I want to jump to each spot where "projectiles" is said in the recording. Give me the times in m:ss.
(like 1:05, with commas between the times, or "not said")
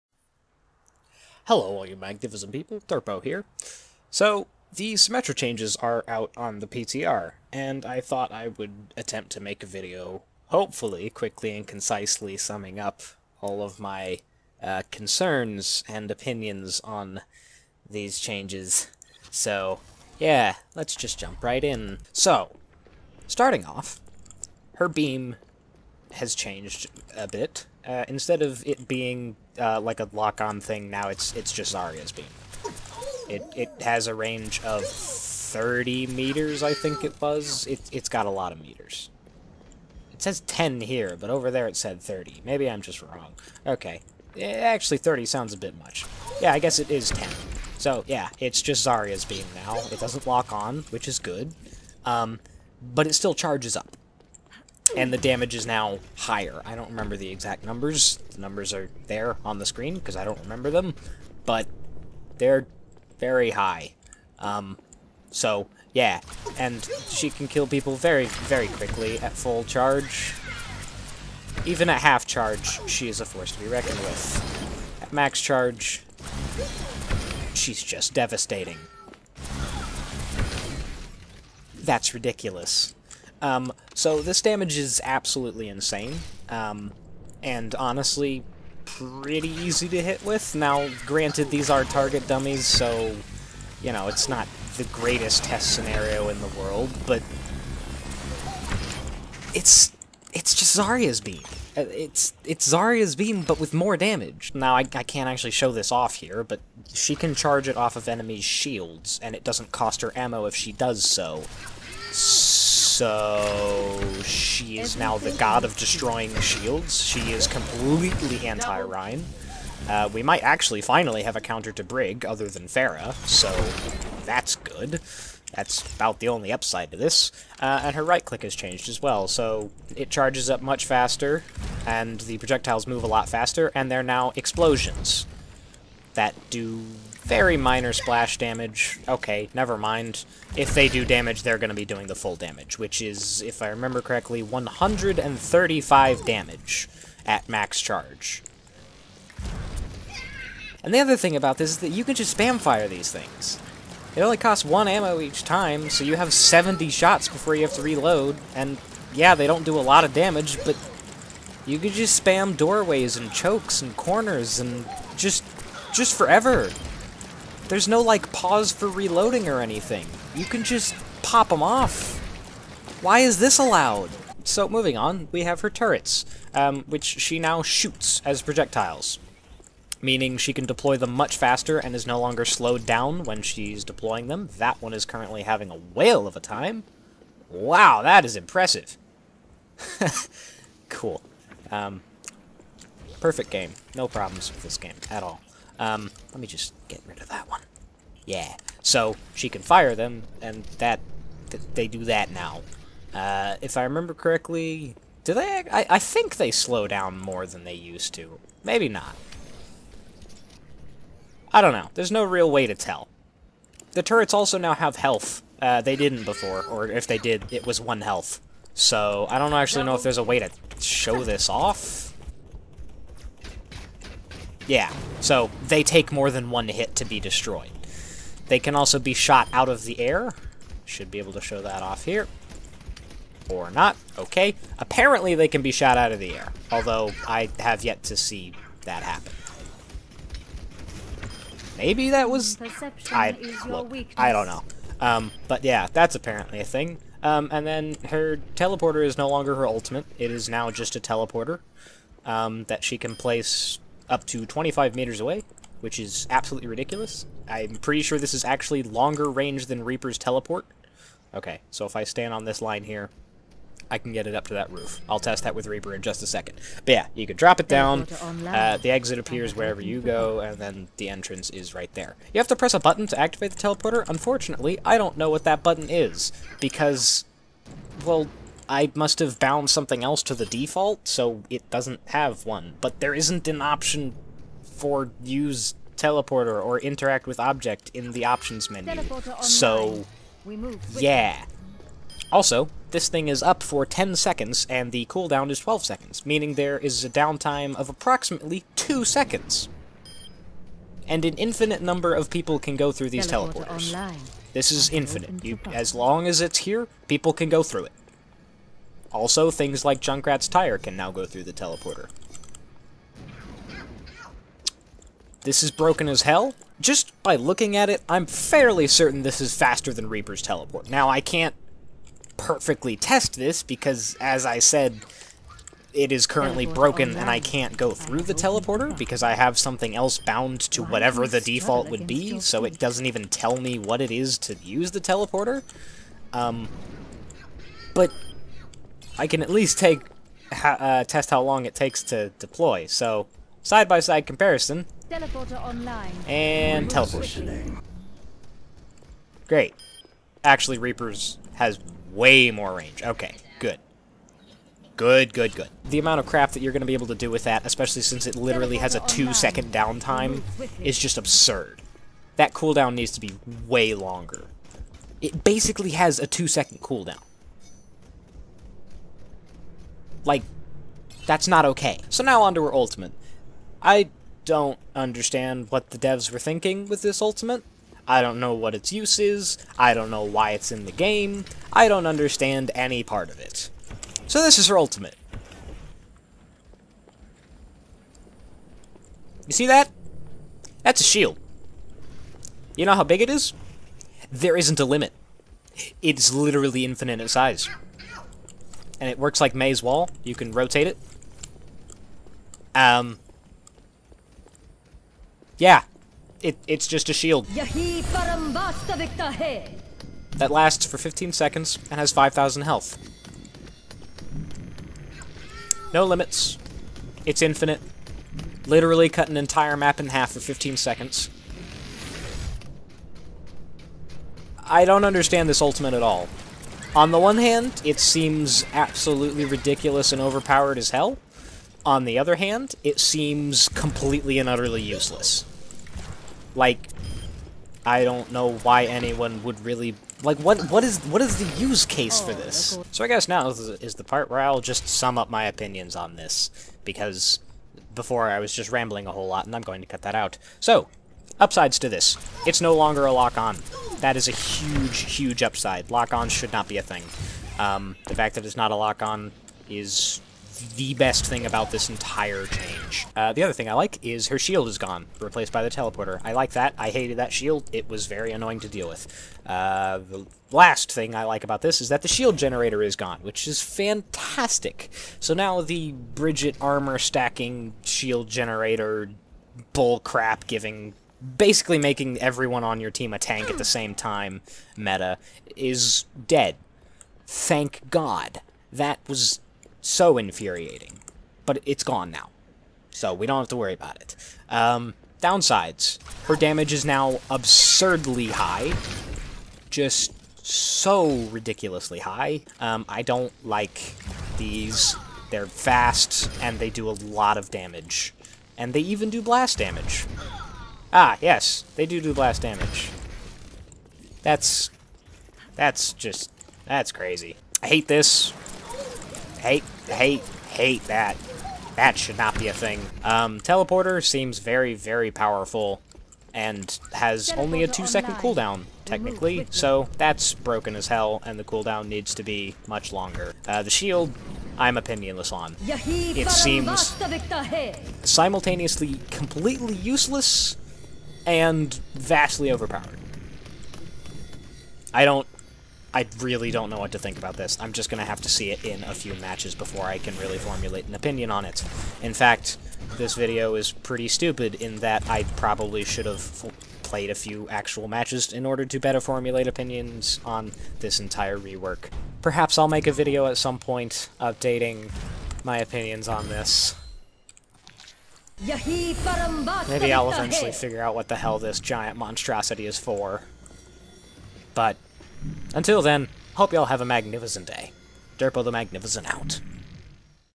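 2:12, 2:58.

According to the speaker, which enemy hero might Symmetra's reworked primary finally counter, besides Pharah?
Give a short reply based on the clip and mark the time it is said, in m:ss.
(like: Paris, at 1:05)
Brig, at 2:01.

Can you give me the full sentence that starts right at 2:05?
That's about the only upside to this.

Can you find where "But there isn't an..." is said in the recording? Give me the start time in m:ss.
4:42.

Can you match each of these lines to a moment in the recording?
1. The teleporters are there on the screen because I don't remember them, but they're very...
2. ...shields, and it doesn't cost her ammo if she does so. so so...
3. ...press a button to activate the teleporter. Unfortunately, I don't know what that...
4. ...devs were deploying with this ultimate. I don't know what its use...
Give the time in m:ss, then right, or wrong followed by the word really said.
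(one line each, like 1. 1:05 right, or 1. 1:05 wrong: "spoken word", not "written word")
1. 0:58 wrong: "numbers", not "teleporters"
2. 1:48 right
3. 4:32 right
4. 6:15 wrong: "thinking", not "deploying".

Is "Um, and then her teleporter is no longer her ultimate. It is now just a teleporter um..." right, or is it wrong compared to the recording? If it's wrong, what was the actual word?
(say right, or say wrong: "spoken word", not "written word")
right.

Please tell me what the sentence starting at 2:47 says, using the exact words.
There's no, like, pause for reloading or anything.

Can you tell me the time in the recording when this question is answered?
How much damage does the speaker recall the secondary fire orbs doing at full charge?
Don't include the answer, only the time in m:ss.
2:24.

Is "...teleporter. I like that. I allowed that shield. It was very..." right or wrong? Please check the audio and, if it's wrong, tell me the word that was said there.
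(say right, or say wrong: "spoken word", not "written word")
wrong: "hated", not "allowed".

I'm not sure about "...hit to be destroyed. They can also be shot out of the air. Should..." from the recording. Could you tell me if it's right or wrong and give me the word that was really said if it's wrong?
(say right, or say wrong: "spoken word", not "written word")
right.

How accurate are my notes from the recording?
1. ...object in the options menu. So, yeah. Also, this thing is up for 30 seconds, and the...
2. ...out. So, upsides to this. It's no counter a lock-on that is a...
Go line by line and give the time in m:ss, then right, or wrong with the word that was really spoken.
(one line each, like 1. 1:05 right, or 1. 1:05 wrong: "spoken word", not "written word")
1. 4:47 wrong: "10", not "30"
2. 7:30 wrong: "longer", not "counter".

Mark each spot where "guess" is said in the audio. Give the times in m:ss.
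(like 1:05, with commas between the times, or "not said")
0:46, 7:23.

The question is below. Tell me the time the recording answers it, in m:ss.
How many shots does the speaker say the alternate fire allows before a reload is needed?
2:36.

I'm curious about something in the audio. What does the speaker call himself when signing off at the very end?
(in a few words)
Derpo the Magnificent.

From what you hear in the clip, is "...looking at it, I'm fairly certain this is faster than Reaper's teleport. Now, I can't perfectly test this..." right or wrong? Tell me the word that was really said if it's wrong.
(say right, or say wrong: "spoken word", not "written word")
right.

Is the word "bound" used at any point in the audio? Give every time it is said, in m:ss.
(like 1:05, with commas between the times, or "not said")
4:39, 5:30.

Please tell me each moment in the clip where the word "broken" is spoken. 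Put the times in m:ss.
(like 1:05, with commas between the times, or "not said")
5:15, 5:26, 8:50.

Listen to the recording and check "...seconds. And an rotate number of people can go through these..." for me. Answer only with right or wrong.
wrong.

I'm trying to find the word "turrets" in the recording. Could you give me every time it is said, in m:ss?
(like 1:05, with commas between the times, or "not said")
2:55, 3:34.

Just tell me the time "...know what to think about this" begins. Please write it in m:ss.
9:06.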